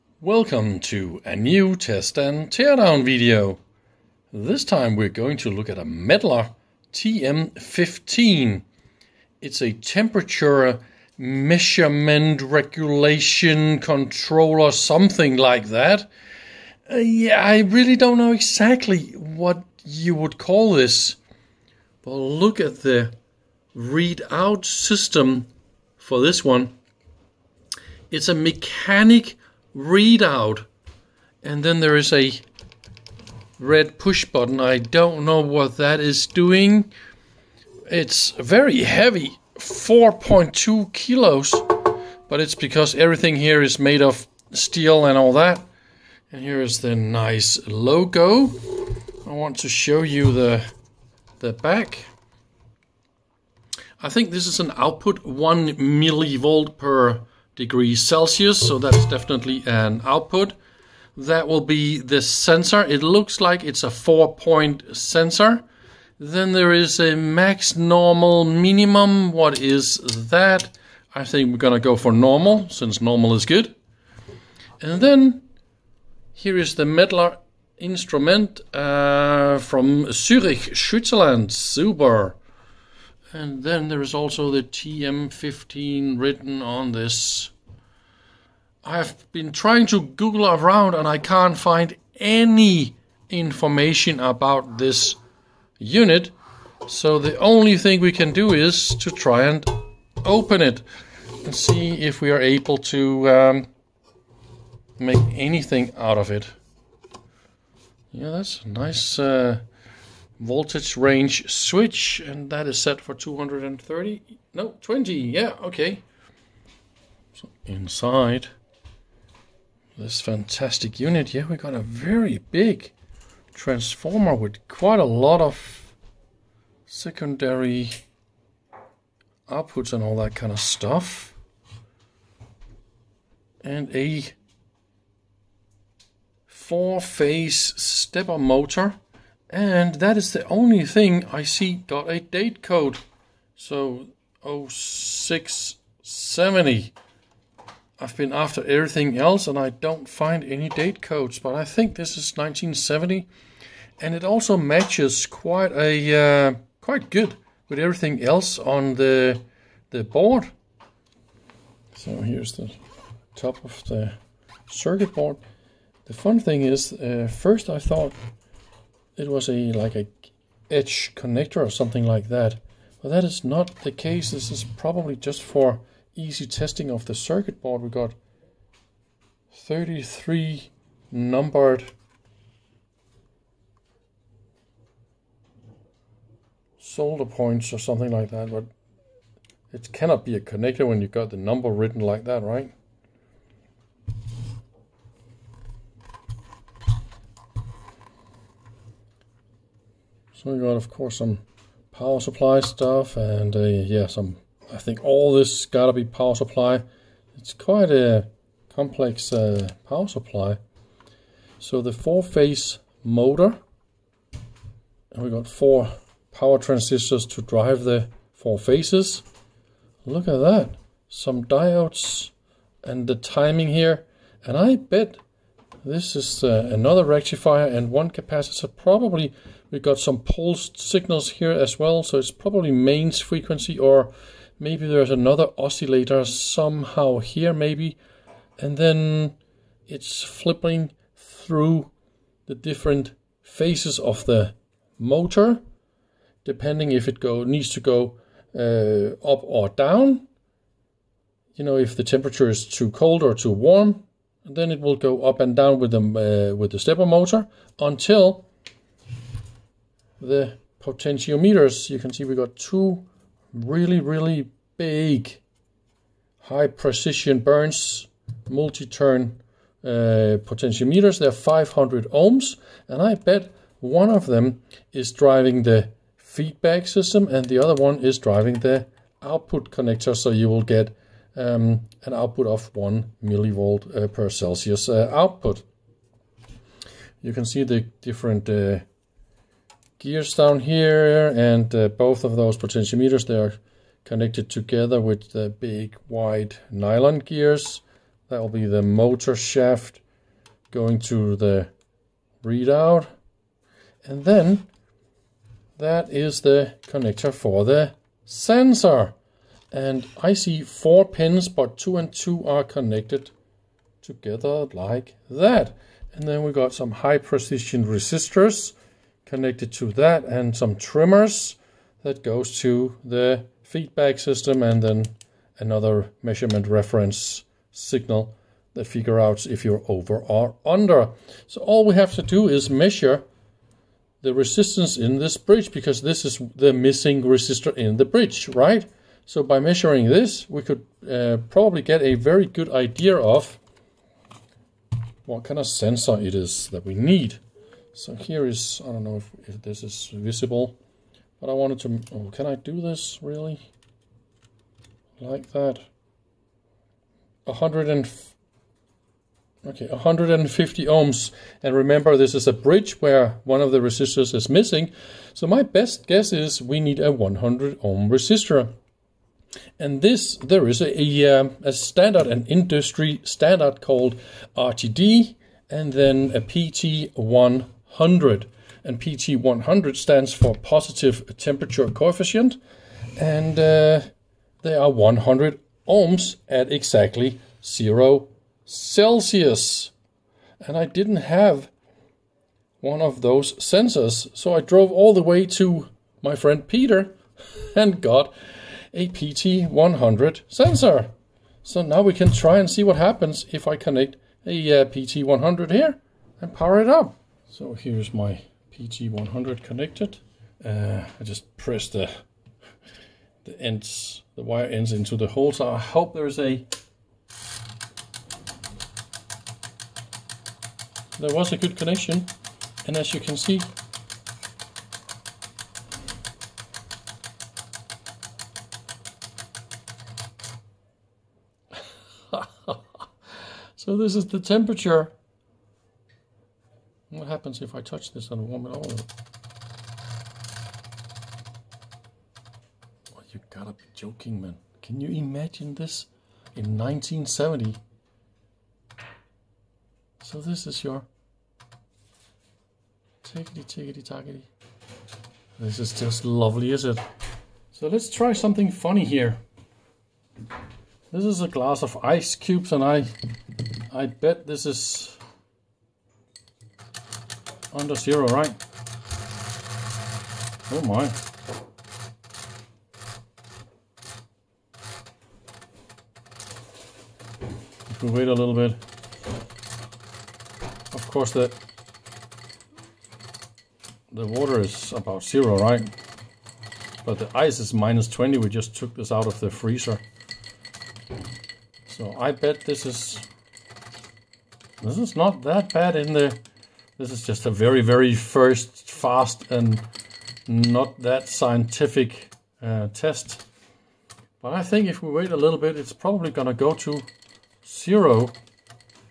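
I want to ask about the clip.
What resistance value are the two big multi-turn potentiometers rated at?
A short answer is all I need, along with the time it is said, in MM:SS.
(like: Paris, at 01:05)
500 ohms, at 04:31.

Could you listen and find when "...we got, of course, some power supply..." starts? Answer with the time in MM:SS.
03:20.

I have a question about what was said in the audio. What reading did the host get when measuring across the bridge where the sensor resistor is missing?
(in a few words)
150 ohms.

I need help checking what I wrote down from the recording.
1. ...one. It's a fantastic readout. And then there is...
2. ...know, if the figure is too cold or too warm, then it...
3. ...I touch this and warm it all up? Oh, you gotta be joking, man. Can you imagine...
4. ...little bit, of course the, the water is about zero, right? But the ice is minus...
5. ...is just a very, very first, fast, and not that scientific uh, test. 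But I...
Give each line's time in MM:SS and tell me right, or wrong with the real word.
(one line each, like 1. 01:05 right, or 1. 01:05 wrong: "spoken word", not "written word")
1. 00:26 wrong: "mechanic", not "fantastic"
2. 04:11 wrong: "temperature", not "figure"
3. 07:17 right
4. 07:58 right
5. 08:17 right.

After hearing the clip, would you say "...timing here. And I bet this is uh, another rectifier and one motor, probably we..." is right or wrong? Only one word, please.
wrong.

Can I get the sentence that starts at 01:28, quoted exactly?
I've been trying to Google around and I can't find any information about this unit.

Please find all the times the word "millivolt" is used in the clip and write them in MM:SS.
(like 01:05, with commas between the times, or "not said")
00:55, 04:43.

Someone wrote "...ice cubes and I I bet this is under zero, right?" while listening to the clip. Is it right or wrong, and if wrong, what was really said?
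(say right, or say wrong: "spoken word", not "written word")
right.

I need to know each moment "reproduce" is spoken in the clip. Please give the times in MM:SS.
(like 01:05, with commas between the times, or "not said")
not said.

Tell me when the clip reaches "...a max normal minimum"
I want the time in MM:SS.
01:06.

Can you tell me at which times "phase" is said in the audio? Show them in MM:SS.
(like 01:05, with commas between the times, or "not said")
02:17, 03:31, 03:38, 04:03.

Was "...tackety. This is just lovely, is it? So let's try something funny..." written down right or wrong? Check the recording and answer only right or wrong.
right.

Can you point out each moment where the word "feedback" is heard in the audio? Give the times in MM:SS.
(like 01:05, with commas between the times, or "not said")
04:36, 05:23.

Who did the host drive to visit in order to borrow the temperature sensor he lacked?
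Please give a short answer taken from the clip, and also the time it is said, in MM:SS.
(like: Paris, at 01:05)
Peter, at 06:36.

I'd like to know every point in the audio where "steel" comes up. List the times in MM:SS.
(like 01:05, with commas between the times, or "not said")
00:44.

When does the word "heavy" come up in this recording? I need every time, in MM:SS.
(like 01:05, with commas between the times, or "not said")
00:38.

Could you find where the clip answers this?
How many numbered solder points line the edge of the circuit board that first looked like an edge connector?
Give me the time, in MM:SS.
02:59.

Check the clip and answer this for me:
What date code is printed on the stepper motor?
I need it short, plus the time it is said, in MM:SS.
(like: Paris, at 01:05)
0670, at 02:24.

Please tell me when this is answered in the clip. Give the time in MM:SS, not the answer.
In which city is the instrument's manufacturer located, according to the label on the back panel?
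01:20.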